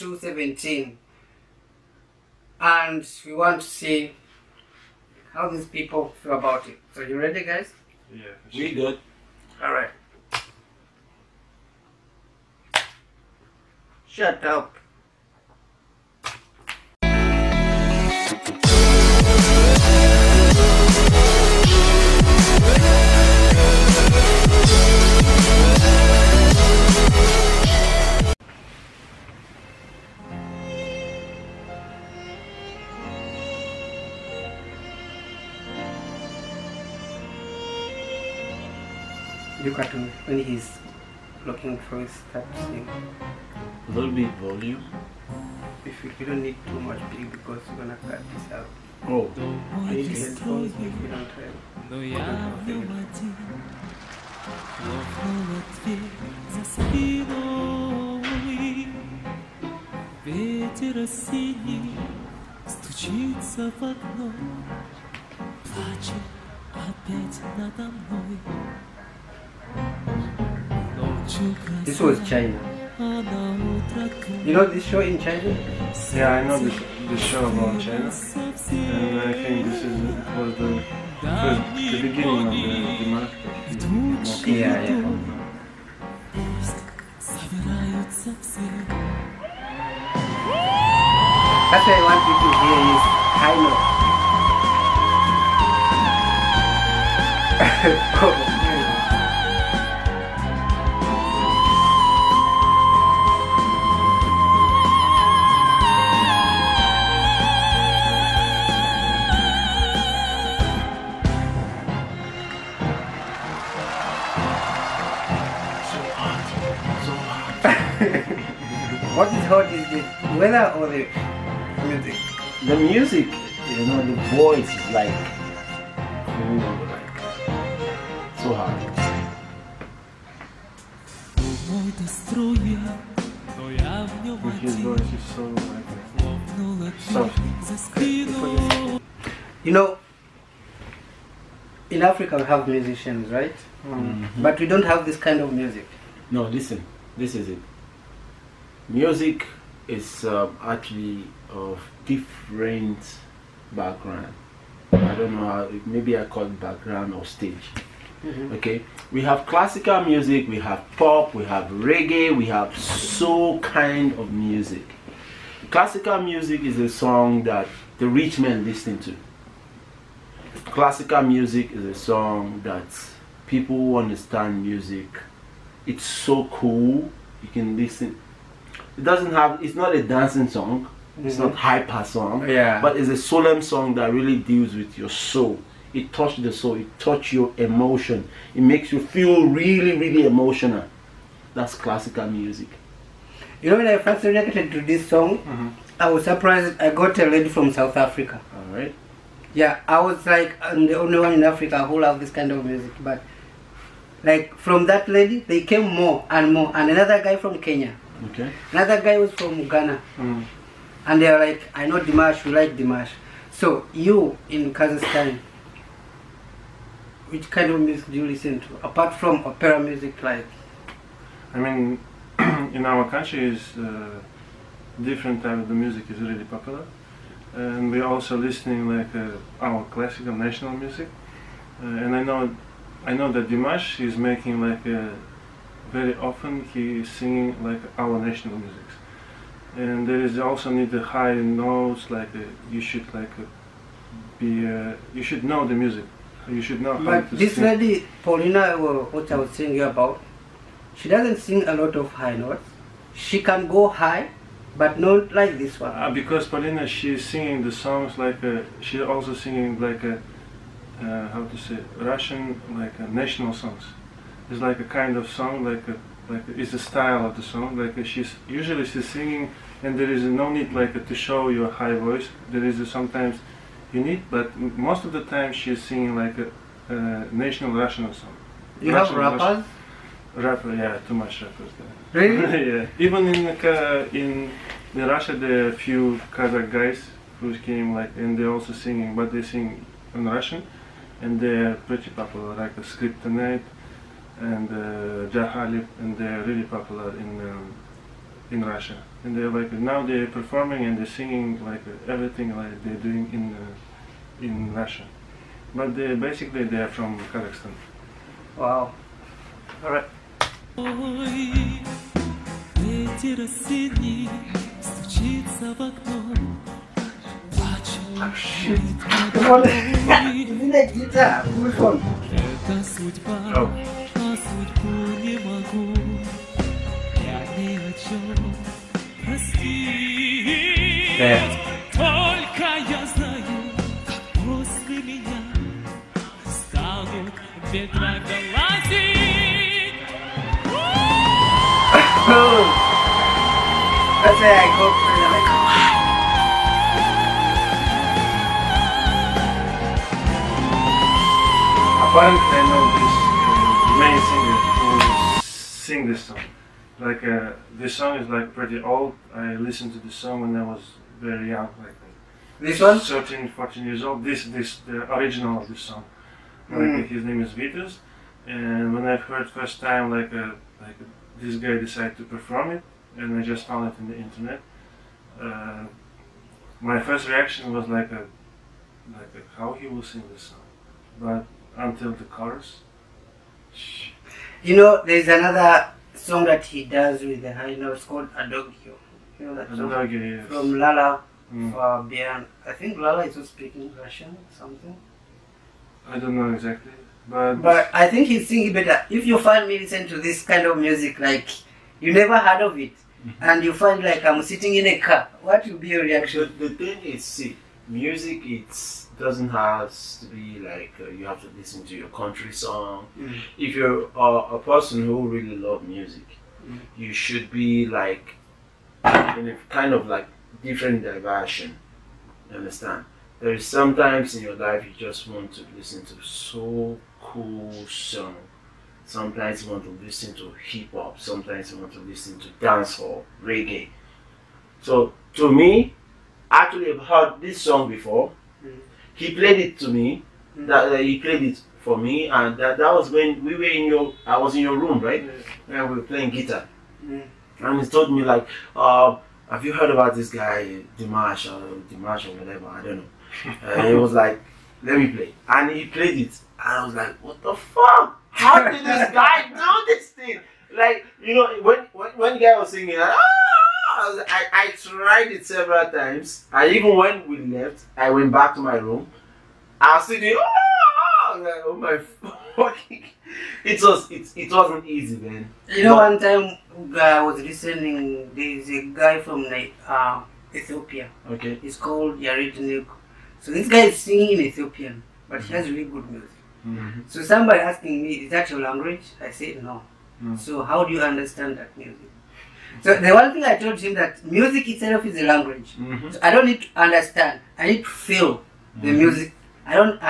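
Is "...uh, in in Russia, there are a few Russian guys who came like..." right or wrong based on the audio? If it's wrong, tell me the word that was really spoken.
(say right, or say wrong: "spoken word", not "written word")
wrong: "Kazakh", not "Russian".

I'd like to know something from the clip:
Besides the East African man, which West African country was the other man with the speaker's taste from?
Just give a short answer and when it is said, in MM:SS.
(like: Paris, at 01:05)
Ghana, at 03:29.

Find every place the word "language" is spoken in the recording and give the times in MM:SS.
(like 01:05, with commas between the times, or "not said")
08:08, 08:15.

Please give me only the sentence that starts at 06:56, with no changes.
you should be like in a kind of like different diversion.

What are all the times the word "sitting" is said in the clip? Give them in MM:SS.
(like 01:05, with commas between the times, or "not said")
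06:44, 07:50.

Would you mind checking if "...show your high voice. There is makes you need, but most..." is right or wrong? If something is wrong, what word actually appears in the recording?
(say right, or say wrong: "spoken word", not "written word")
wrong: "sometimes", not "makes".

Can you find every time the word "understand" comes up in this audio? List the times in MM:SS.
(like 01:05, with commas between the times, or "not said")
02:53, 07:02, 08:11, 08:16.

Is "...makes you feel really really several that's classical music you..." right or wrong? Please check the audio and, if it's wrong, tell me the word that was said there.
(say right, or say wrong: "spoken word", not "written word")
wrong: "emotional", not "several".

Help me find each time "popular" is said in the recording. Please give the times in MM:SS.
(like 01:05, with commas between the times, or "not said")
03:46, 04:52, 04:56.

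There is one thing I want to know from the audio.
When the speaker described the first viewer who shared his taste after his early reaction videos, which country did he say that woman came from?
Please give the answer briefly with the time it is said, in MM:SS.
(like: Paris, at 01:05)
South Africa, at 03:17.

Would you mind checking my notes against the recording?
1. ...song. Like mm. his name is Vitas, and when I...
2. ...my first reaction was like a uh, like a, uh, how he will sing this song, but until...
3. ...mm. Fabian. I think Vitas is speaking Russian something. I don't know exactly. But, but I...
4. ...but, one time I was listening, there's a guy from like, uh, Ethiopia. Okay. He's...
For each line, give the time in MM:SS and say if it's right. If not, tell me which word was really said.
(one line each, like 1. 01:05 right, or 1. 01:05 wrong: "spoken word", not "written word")
1. 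06:05 right
2. 06:16 right
3. 06:31 wrong: "Lala", not "Vitas"
4. 07:55 right.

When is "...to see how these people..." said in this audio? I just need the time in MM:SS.
00:03.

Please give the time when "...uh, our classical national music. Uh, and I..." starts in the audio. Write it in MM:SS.
03:49.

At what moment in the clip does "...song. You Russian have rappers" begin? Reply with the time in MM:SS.
04:38.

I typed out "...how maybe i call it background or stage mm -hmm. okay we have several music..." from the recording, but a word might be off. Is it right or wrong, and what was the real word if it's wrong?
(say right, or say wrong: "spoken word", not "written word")
wrong: "classical", not "several".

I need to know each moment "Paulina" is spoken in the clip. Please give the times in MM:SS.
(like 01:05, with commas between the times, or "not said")
04:08, 04:16.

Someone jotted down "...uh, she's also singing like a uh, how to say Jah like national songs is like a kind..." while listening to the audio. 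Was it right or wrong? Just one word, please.
wrong.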